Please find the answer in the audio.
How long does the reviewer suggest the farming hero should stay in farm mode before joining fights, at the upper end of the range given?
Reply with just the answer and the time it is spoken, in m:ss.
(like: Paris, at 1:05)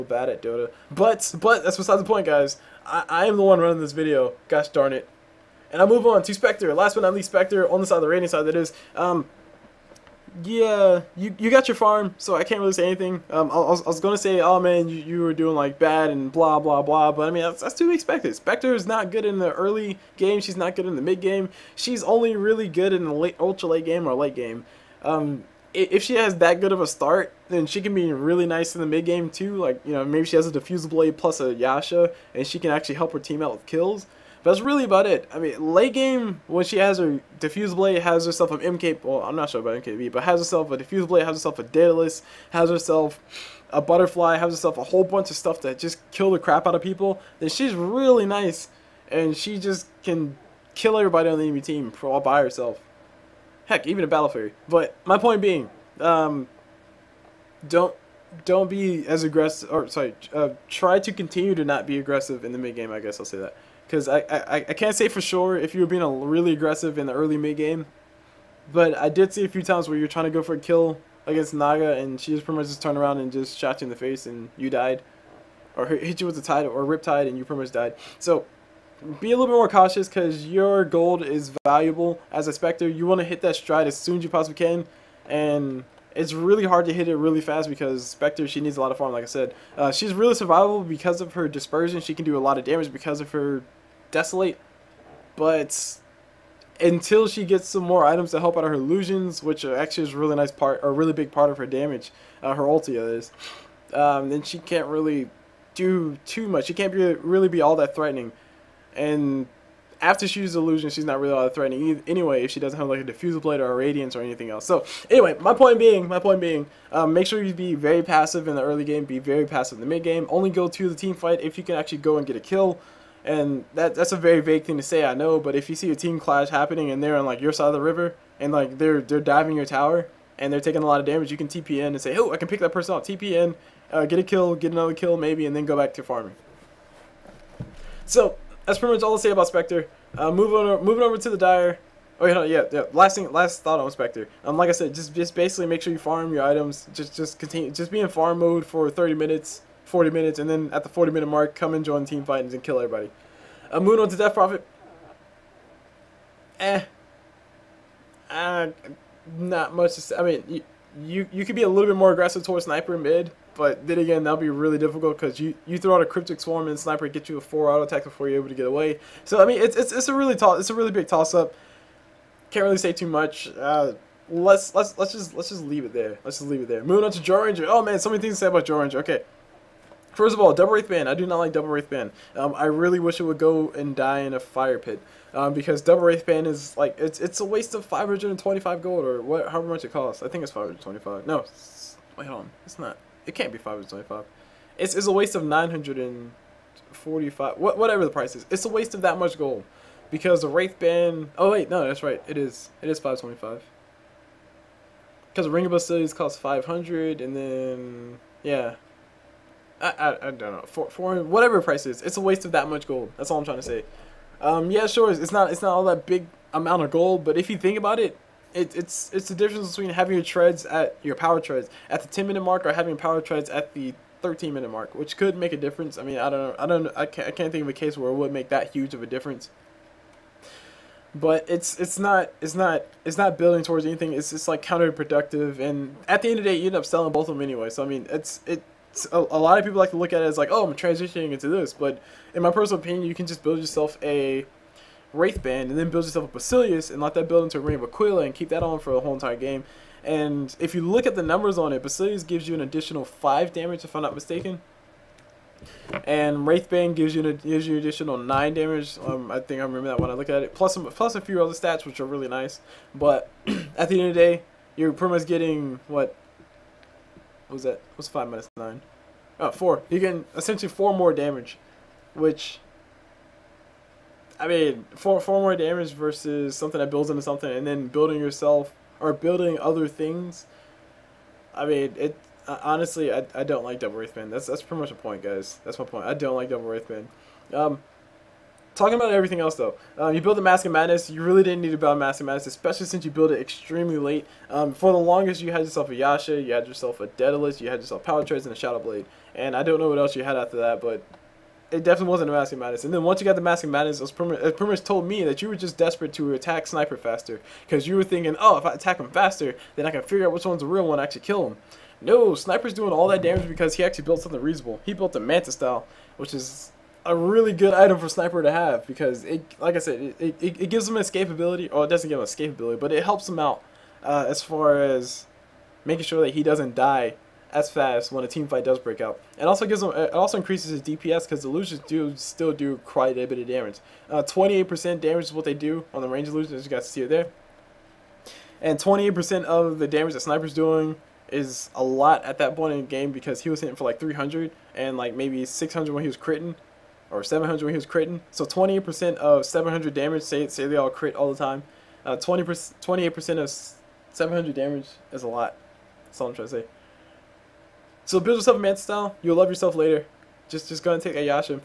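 40 minutes, at 2:29.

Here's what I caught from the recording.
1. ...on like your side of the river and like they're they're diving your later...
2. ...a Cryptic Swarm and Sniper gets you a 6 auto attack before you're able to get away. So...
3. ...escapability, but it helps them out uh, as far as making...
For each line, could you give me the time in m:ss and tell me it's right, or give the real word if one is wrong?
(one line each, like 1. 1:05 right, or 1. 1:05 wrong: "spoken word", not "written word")
1. 2:07 wrong: "tower", not "later"
2. 2:46 wrong: "4", not "6"
3. 5:22 right.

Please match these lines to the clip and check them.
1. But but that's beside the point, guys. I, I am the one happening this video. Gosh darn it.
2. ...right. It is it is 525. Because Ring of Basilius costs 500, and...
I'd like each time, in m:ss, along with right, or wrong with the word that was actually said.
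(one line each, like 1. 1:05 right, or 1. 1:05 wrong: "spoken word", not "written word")
1. 0:00 wrong: "running", not "happening"
2. 3:22 right.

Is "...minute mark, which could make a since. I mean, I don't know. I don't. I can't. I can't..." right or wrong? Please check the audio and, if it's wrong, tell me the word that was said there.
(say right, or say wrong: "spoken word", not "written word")
wrong: "difference", not "since".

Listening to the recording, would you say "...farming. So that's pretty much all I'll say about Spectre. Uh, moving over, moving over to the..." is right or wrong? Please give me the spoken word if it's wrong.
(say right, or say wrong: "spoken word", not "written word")
right.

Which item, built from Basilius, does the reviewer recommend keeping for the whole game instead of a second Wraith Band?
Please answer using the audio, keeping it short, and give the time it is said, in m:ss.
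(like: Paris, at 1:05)
Ring of Aquila, at 4:07.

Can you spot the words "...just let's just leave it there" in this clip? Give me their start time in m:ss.
2:55.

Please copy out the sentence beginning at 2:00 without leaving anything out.
Only go to the team fight if you can actually go and get a kill.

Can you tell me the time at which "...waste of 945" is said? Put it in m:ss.
3:15.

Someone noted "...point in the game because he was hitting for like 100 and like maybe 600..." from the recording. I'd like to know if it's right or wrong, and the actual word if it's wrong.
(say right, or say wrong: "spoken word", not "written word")
wrong: "300", not "100".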